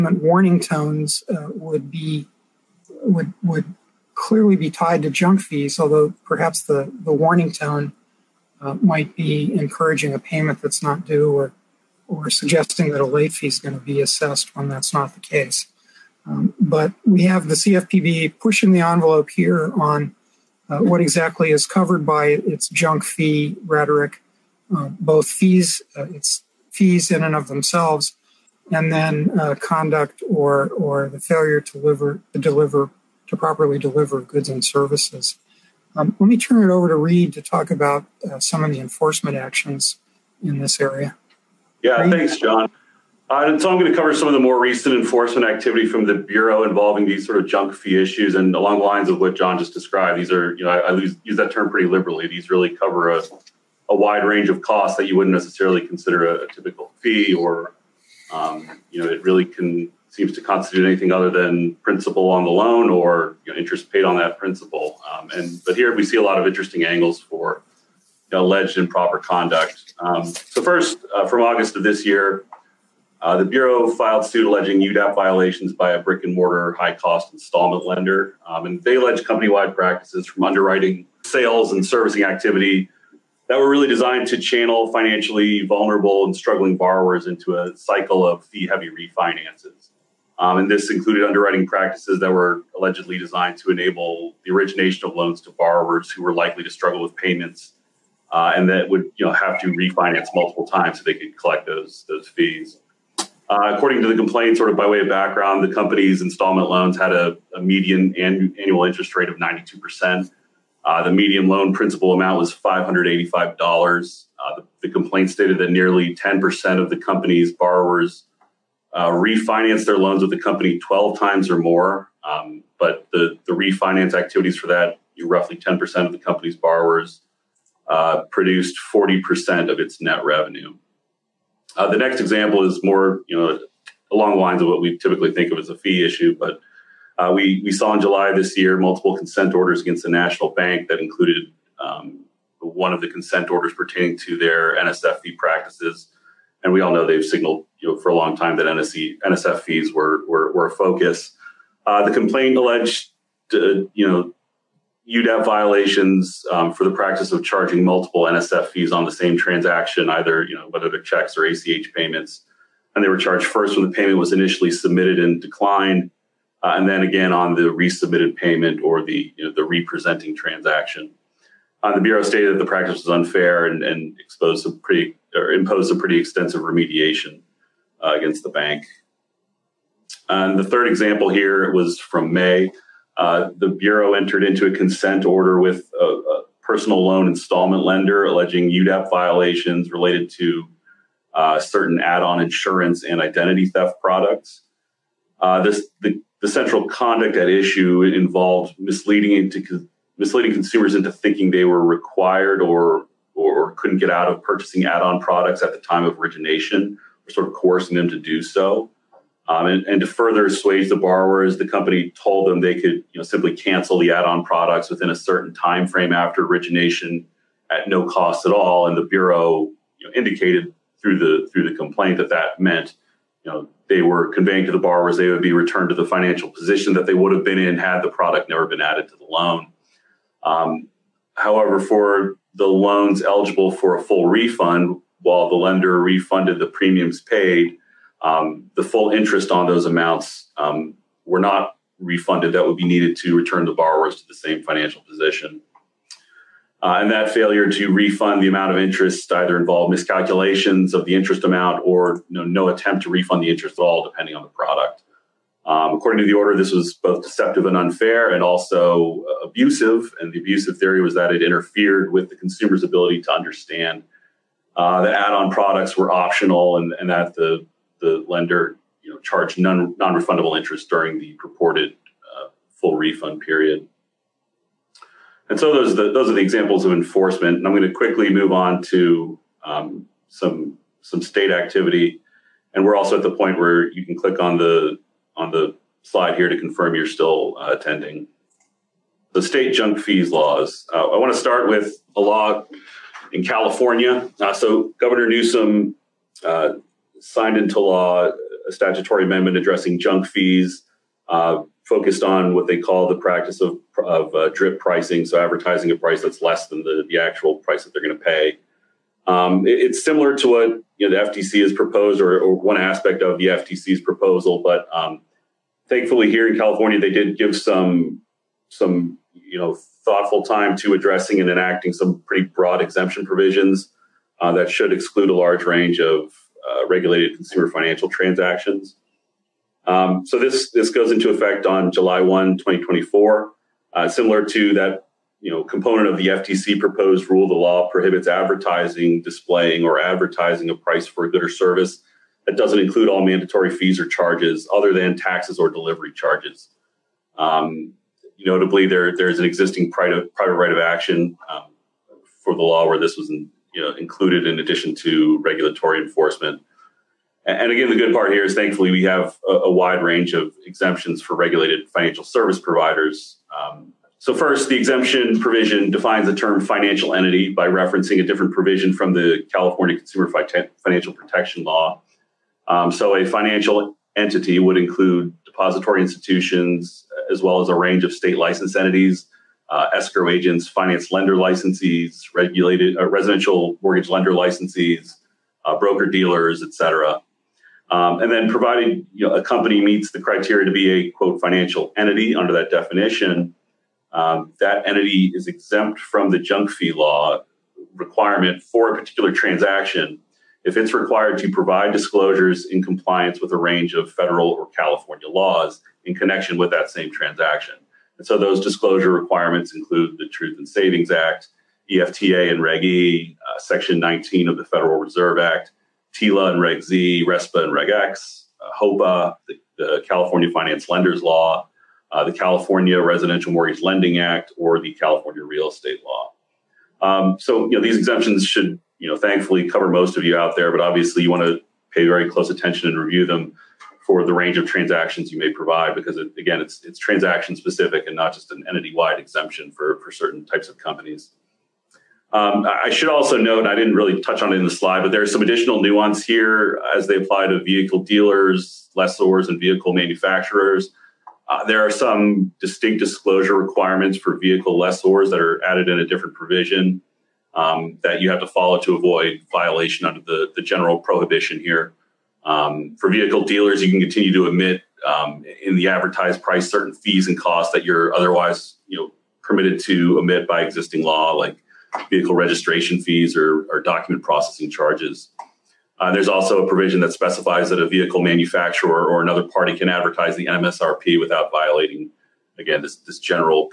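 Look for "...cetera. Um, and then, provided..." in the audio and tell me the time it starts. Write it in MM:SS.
06:26.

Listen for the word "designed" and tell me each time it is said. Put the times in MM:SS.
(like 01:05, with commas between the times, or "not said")
01:23, 01:33.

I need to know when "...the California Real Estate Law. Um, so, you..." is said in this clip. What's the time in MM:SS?
07:04.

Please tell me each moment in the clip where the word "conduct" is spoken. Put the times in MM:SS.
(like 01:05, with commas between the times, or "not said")
00:29, 01:09, 03:16.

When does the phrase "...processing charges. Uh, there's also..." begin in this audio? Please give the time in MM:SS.
07:54.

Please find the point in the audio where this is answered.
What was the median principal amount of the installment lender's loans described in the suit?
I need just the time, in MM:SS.
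01:52.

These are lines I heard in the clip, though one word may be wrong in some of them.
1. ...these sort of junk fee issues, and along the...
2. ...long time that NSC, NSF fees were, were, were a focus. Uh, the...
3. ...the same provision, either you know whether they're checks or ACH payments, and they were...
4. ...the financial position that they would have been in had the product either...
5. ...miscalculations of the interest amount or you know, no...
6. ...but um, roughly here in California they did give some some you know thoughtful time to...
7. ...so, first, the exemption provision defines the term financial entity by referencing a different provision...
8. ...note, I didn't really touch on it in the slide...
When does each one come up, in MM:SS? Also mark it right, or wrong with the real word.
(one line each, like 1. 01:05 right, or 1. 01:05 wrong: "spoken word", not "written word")
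1. 00:47 right
2. 02:28 right
3. 02:39 wrong: "transaction", not "provision"
4. 03:45 wrong: "never", not "either"
5. 04:09 right
6. 05:14 wrong: "thankfully", not "roughly"
7. 06:04 right
8. 07:23 right.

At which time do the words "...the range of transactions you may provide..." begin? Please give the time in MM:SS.
07:14.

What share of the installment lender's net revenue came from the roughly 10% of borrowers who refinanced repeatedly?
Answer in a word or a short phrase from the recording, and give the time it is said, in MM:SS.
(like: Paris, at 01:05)
40%, at 02:08.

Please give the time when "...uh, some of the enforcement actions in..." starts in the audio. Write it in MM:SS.
00:38.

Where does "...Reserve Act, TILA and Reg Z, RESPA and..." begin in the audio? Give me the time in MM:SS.
06:54.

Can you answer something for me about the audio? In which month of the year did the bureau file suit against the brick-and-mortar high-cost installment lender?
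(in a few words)
August.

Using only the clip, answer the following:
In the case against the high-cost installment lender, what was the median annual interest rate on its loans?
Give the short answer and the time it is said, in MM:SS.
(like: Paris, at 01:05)
92%, at 01:49.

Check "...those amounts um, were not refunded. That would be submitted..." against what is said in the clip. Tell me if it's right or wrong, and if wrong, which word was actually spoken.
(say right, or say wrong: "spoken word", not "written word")
wrong: "needed", not "submitted".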